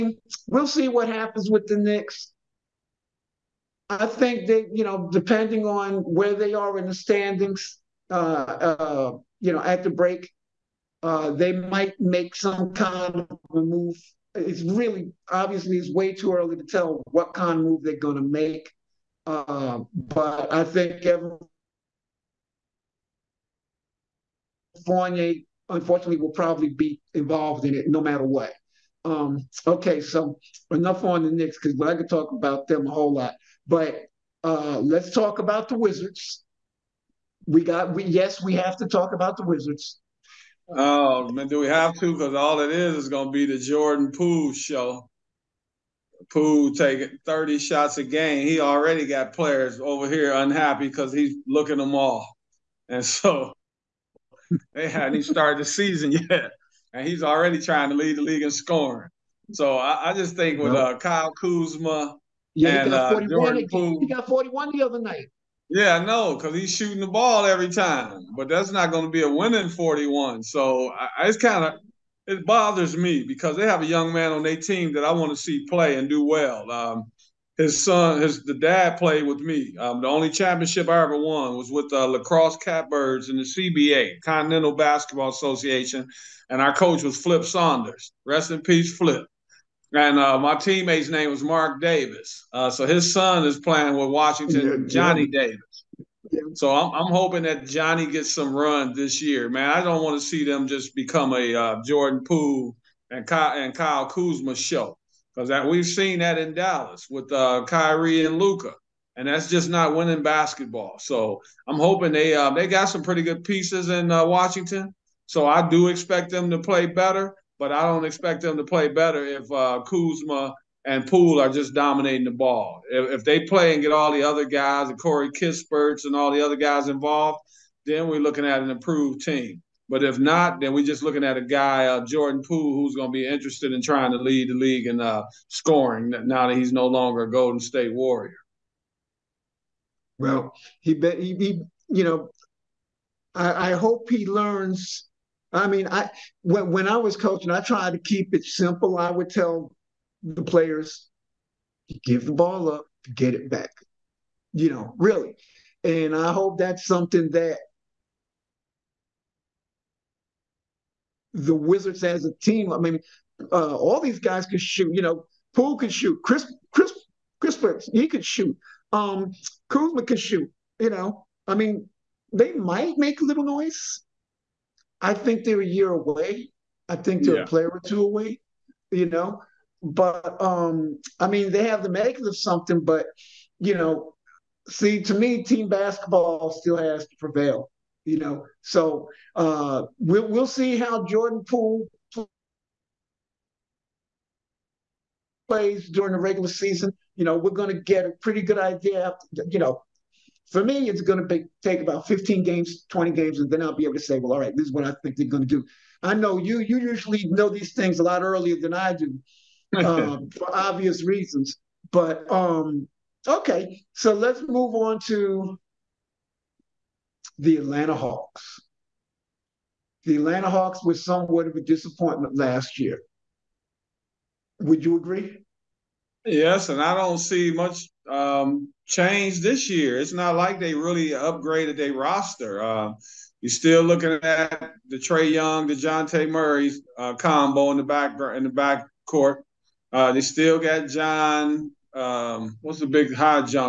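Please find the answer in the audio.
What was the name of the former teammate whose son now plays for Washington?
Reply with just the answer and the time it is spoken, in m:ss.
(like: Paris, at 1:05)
Mark Davis, at 1:31.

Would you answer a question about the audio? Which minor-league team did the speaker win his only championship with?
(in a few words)
La Crosse Catbirds.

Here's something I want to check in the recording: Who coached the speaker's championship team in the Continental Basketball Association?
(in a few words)
Flip Saunders.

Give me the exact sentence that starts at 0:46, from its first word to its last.
Poole taking 30 shots a game.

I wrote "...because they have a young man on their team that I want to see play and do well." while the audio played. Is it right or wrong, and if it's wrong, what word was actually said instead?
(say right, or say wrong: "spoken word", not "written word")
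right.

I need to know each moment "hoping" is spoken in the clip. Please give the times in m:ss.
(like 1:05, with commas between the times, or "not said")
1:37, 1:51.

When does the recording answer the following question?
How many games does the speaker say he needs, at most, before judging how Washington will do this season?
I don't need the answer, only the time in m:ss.
3:22.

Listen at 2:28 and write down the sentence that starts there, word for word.
I would tell the players, give the ball up, get it back.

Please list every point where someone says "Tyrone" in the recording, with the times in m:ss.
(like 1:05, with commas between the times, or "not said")
not said.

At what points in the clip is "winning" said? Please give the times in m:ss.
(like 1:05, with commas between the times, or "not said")
1:09, 1:49.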